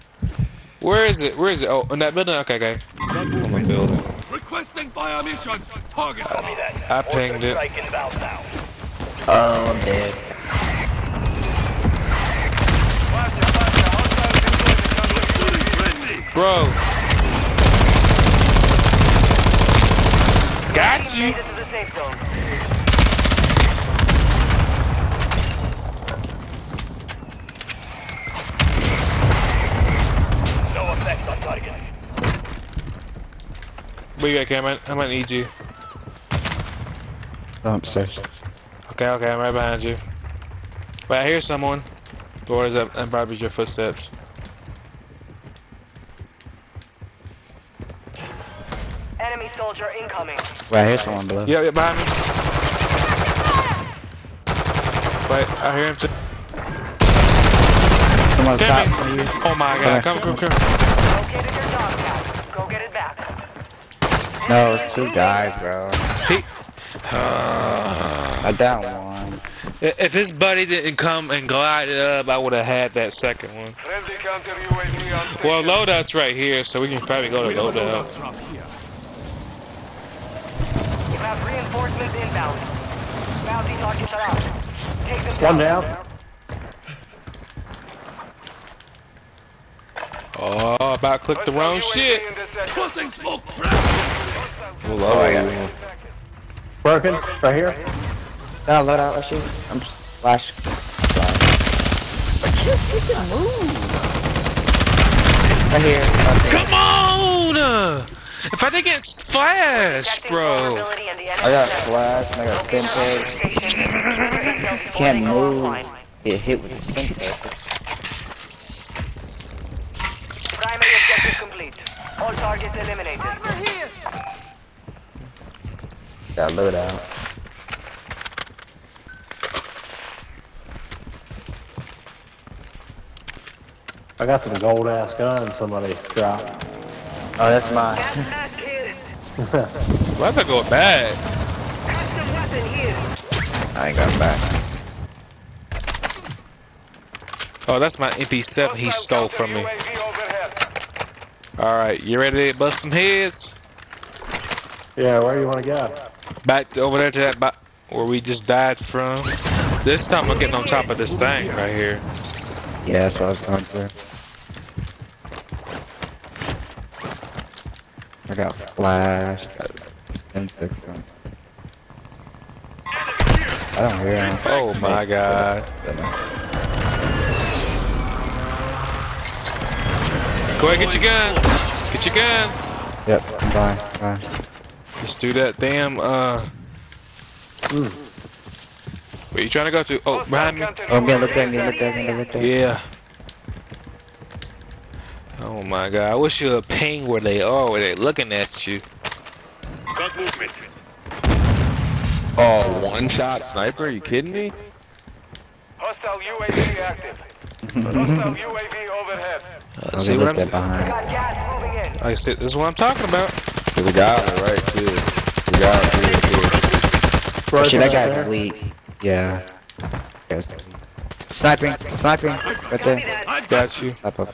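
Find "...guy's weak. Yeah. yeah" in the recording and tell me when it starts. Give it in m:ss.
3:37.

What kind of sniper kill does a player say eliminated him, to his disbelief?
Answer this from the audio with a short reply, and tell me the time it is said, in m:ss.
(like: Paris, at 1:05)
One shot, at 3:22.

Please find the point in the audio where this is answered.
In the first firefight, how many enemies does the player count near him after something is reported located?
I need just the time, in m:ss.
1:04.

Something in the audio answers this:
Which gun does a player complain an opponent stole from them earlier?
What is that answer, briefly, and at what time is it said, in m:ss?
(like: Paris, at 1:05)
MP7, at 2:28.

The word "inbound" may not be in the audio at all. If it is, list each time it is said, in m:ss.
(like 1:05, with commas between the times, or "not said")
1:22.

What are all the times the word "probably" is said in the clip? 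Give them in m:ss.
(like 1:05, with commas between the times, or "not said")
0:43, 1:16.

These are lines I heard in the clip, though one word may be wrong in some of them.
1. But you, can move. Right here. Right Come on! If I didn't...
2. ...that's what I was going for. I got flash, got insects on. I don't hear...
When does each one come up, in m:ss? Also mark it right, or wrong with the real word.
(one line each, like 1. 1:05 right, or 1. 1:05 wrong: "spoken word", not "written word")
1. 1:42 right
2. 2:43 right.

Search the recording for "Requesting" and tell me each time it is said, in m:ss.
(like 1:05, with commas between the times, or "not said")
0:04.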